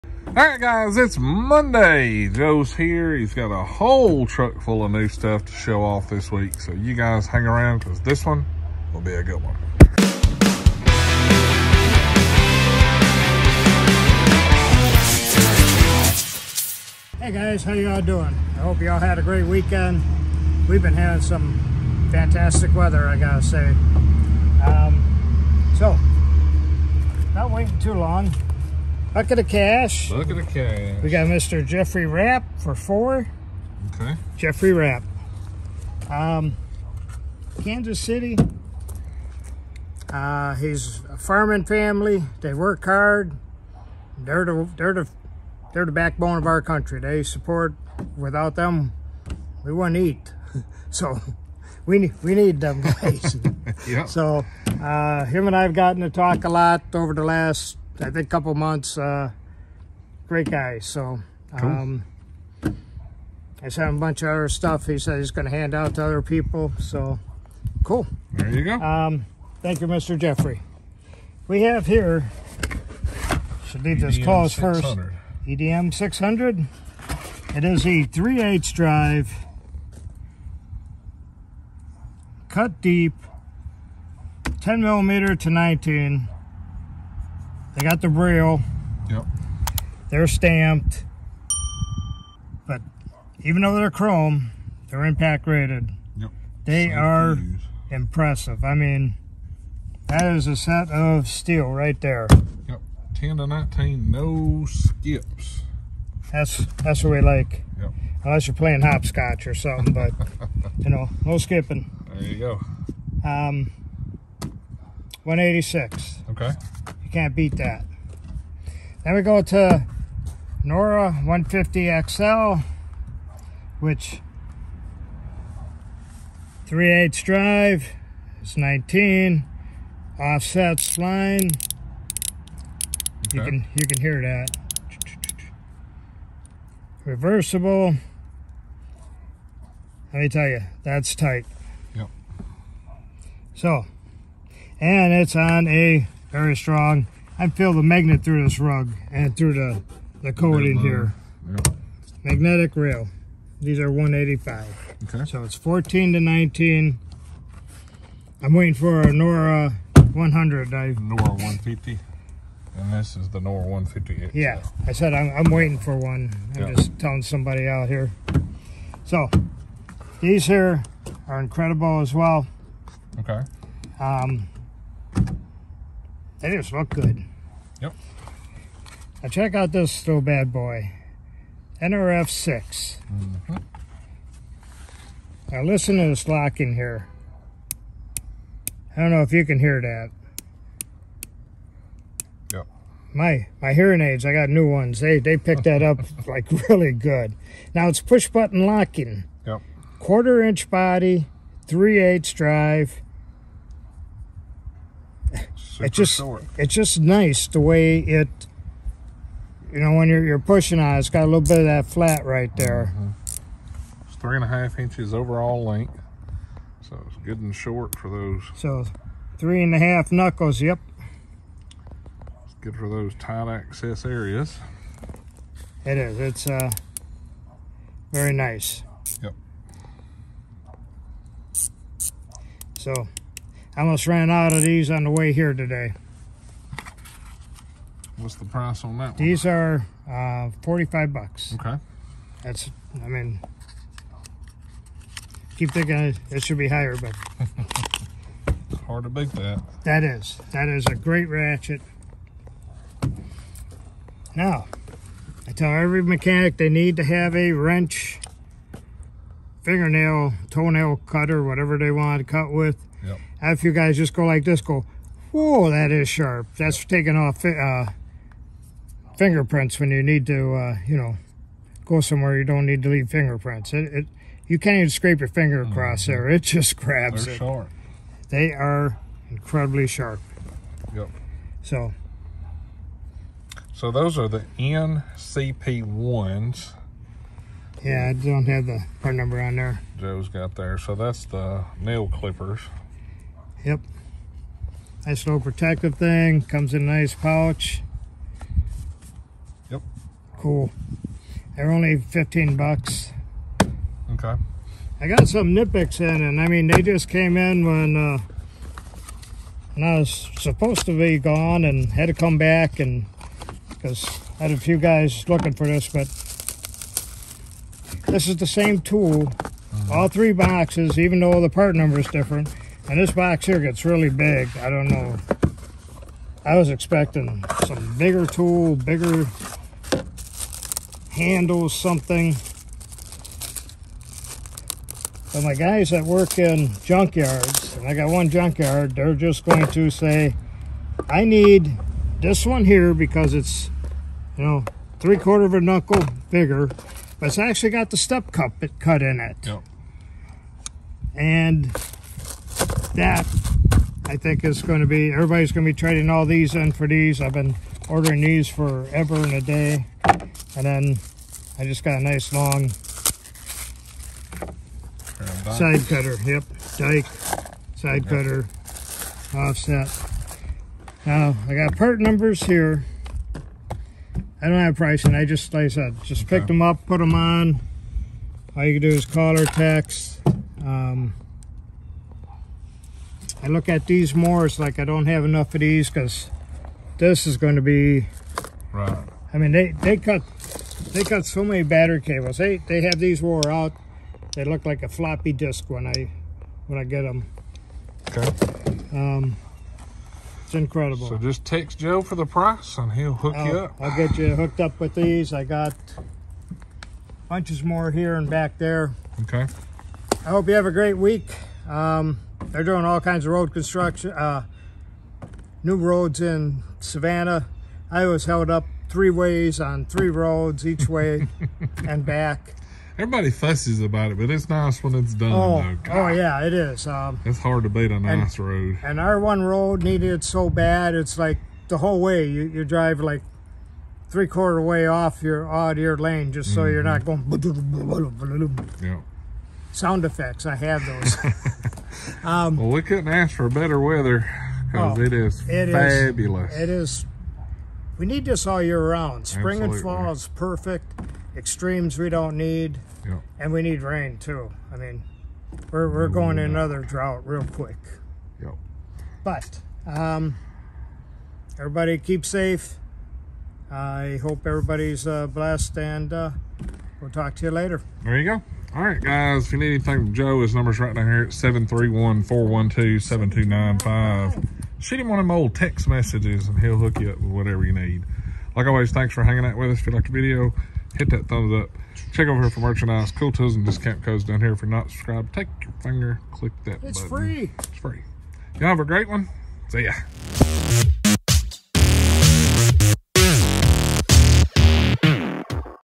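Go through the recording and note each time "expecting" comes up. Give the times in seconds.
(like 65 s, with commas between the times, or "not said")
326 s.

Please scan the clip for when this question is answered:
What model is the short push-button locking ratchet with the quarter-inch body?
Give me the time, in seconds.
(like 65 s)
181 s.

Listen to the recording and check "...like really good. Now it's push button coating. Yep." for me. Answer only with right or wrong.
wrong.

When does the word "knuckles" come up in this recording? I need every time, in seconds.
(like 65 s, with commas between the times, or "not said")
220 s, 345 s.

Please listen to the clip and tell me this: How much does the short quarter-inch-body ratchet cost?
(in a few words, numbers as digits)
$45.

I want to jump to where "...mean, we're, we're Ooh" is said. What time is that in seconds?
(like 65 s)
454 s.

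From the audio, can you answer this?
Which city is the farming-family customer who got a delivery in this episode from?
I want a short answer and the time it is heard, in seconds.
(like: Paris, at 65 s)
Kansas City, at 37 s.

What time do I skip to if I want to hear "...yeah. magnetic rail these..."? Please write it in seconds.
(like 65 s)
151 s.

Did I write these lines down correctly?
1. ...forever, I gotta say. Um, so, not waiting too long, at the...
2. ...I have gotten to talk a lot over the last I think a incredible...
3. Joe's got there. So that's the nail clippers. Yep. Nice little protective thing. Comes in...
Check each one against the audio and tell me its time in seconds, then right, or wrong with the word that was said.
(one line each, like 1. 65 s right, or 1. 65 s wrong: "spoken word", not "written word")
1. 22 s wrong: "weather", not "forever"
2. 55 s wrong: "couple", not "incredible"
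3. 289 s right.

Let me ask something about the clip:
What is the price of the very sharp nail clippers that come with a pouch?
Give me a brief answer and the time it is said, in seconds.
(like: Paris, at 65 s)
$15, at 301 s.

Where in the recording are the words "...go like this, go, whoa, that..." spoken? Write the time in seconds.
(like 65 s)
264 s.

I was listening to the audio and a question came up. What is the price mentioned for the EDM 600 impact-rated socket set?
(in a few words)
186.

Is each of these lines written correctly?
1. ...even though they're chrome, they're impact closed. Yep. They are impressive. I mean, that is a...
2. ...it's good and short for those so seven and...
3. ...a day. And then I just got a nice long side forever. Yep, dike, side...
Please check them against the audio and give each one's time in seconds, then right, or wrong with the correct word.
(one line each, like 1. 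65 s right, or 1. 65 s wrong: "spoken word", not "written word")
1. 93 s wrong: "rated", not "closed"
2. 217 s wrong: "three", not "seven"
3. 359 s wrong: "cutter", not "forever".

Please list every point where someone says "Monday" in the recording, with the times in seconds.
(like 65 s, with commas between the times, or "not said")
1 s.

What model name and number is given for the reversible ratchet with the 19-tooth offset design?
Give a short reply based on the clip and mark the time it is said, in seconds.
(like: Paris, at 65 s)
Nora 150 XL, at 120 s.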